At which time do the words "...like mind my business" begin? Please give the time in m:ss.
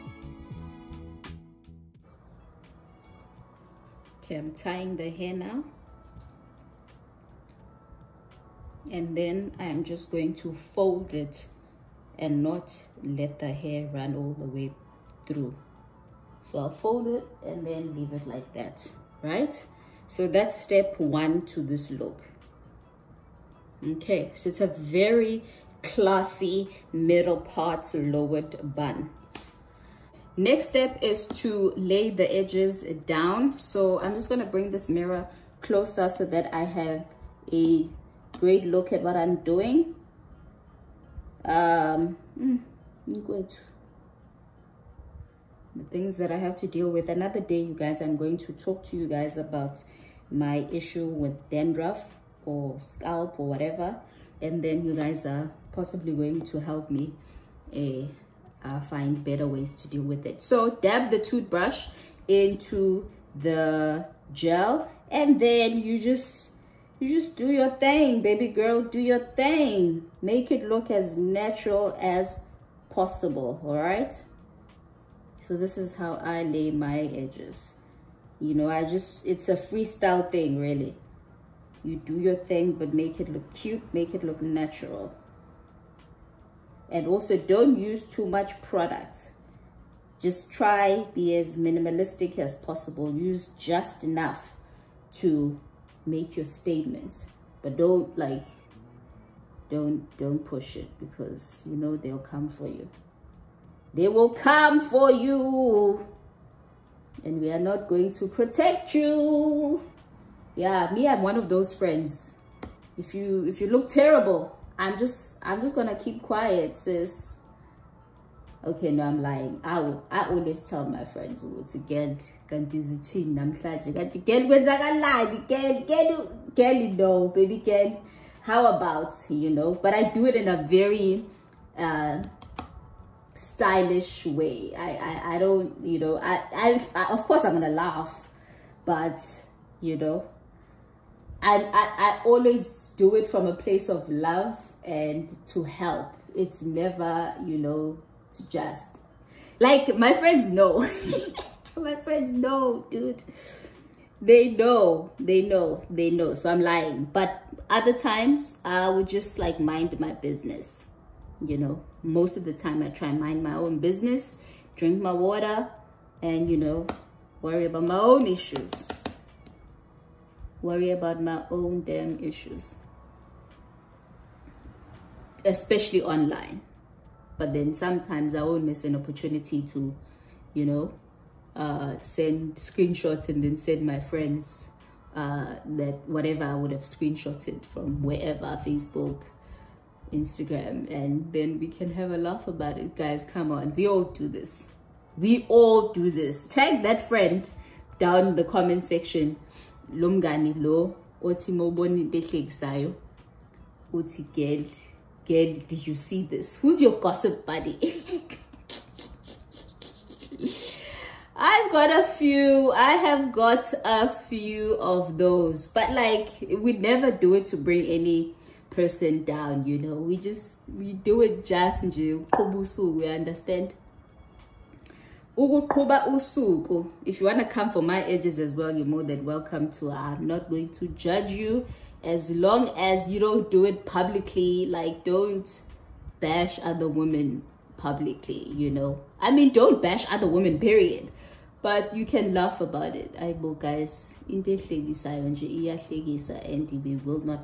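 2:39.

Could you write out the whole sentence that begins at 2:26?
It's never, you know, to just like my friends know.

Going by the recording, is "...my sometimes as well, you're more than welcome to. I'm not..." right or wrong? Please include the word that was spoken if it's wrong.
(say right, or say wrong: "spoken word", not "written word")
wrong: "edges", not "sometimes".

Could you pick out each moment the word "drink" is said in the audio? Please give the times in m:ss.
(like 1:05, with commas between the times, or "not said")
2:44.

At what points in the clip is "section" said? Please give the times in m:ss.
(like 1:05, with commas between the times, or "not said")
3:18.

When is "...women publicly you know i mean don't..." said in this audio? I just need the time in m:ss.
3:56.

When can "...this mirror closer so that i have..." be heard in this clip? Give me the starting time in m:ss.
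0:34.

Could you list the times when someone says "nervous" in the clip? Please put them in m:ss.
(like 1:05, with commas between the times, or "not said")
not said.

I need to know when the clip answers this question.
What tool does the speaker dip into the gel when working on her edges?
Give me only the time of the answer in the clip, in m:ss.
1:01.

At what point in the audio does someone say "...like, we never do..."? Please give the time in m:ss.
3:35.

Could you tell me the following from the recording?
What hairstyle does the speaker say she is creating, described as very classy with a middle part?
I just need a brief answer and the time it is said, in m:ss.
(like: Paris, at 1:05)
Lowered bun, at 0:27.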